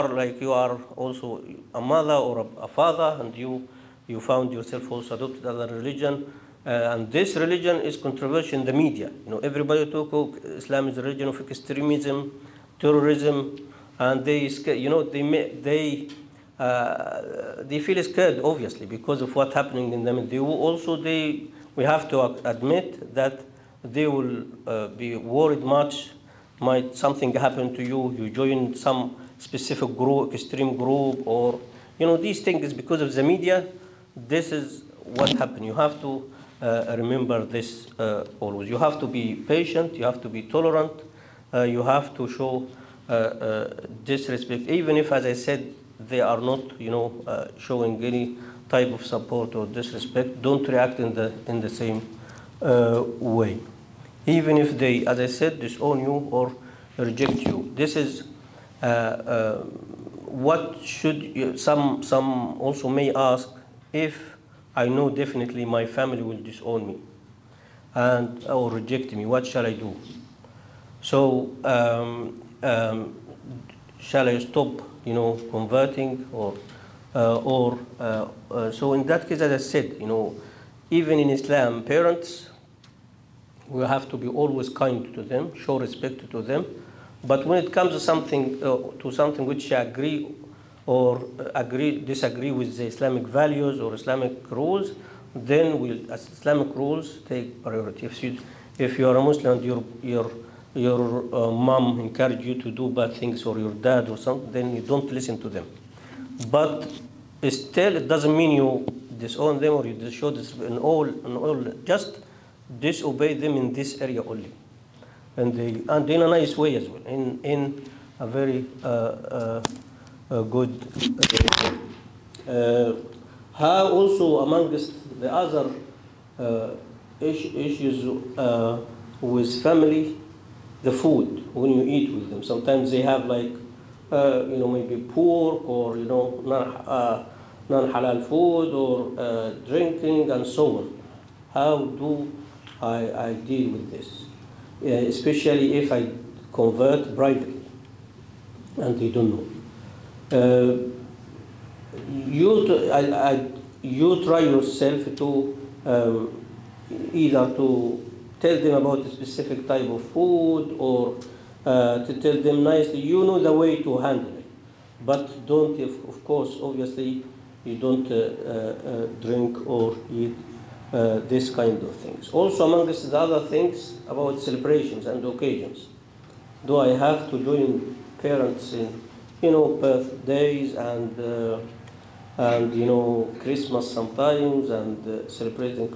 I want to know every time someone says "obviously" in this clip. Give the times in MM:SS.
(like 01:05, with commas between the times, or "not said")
00:18, 02:46.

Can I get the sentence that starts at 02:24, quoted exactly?
Uh, especially if I convert privately and they don't know.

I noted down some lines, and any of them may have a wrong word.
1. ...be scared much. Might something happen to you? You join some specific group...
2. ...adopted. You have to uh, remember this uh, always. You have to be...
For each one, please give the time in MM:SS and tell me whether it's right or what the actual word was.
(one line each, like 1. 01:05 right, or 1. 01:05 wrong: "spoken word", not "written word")
1. 00:24 wrong: "worried", not "scared"
2. 00:35 wrong: "happened", not "adopted".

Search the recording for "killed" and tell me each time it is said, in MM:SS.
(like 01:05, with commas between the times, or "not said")
not said.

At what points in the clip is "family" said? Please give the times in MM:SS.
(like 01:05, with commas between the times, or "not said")
01:05, 02:09.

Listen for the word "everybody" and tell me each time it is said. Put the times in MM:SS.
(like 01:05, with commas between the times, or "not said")
00:09.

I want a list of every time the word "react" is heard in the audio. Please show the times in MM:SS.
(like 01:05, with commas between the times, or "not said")
00:50.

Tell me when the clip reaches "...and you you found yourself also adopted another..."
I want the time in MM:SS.
00:03.